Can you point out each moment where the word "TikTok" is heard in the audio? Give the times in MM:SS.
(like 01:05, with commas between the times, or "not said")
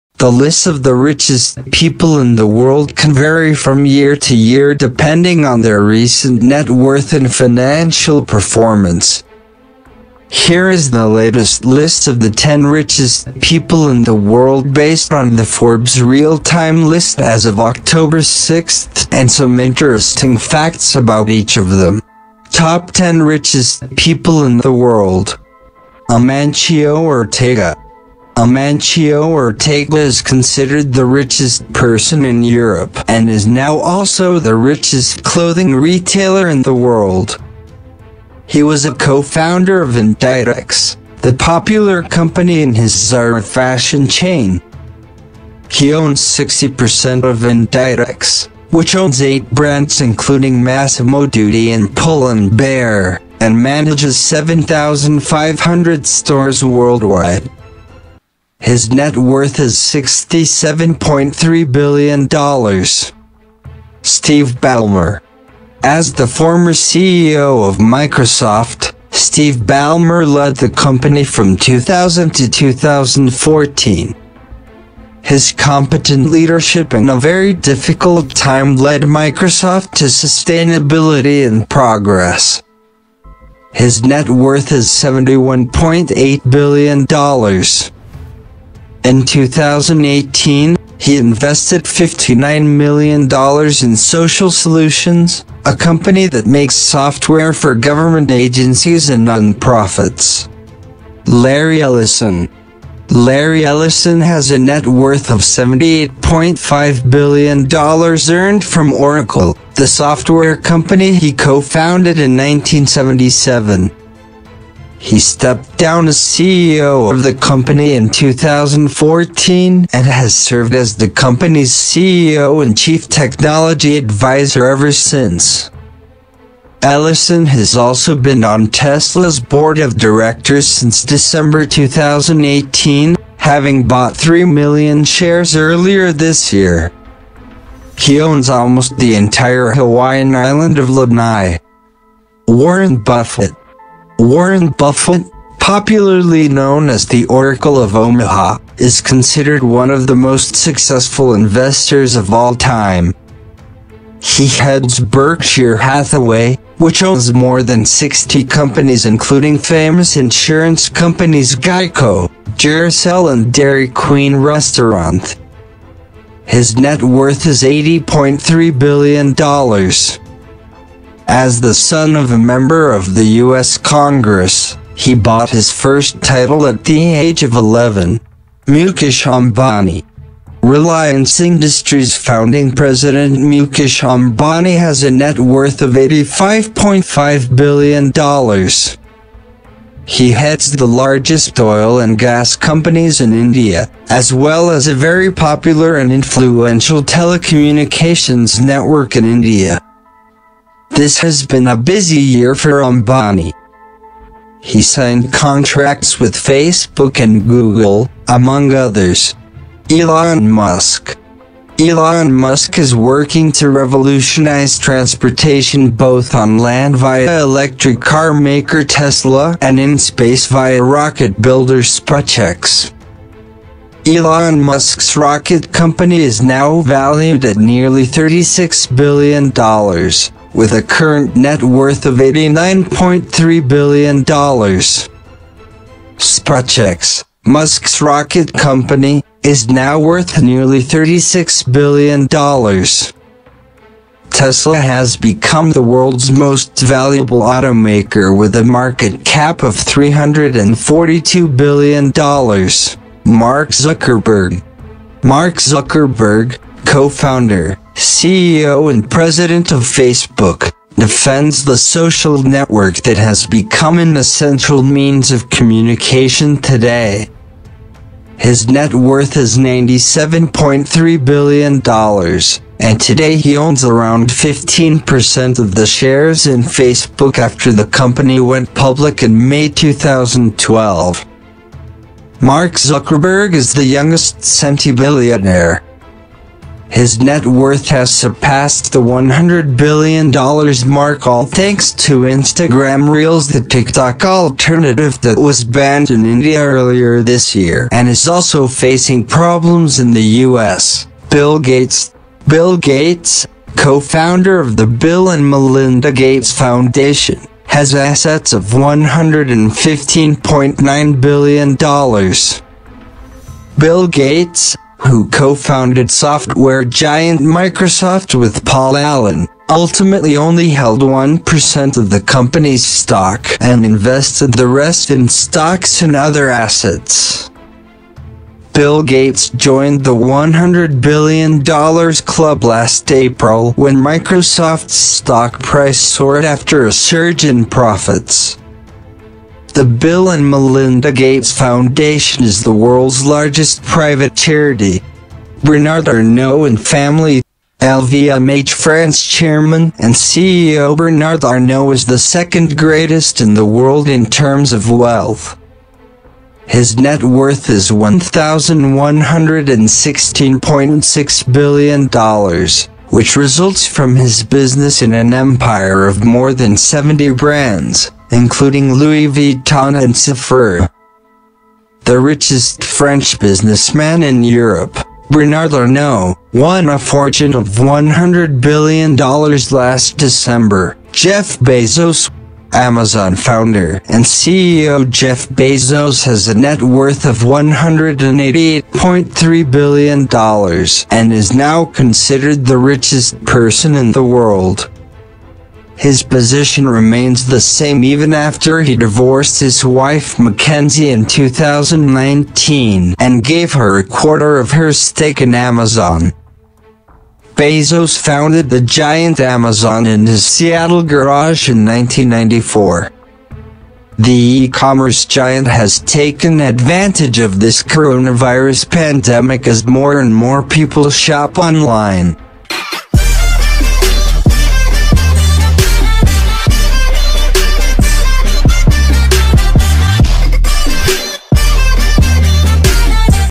04:53.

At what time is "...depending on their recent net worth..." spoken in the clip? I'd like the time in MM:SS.
00:04.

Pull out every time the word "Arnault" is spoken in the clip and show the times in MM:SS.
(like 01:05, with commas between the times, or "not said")
05:46, 05:51, 06:15.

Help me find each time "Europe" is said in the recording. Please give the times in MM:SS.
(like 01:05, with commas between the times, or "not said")
00:32, 06:14.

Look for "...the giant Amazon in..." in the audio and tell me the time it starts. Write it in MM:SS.
06:48.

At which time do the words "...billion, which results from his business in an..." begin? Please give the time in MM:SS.
06:01.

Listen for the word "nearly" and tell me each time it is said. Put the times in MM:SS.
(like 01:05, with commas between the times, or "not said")
03:47, 04:00.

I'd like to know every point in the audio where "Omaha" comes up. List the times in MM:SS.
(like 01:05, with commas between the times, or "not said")
02:27.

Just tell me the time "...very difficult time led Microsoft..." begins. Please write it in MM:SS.
01:17.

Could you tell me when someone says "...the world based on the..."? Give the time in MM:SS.
00:14.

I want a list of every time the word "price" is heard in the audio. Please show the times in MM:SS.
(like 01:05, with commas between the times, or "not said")
05:35.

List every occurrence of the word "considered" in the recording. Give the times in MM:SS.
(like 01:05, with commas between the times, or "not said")
00:30, 02:29, 06:31.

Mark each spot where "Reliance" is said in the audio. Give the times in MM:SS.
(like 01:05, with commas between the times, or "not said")
03:00.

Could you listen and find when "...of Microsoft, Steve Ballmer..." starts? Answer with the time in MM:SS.
01:07.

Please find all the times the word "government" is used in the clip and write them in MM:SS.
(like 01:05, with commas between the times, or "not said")
01:37.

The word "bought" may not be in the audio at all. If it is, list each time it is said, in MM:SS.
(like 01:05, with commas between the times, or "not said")
02:13, 02:55.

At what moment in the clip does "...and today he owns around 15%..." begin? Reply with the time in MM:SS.
04:32.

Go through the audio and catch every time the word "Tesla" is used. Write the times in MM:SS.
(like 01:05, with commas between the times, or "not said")
02:08, 03:38, 04:04.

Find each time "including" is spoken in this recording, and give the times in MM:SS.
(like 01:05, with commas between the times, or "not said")
00:50, 02:39, 06:08.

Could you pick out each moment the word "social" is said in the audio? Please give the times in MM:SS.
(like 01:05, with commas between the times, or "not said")
01:33, 04:21.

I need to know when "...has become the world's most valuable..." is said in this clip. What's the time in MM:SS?
04:04.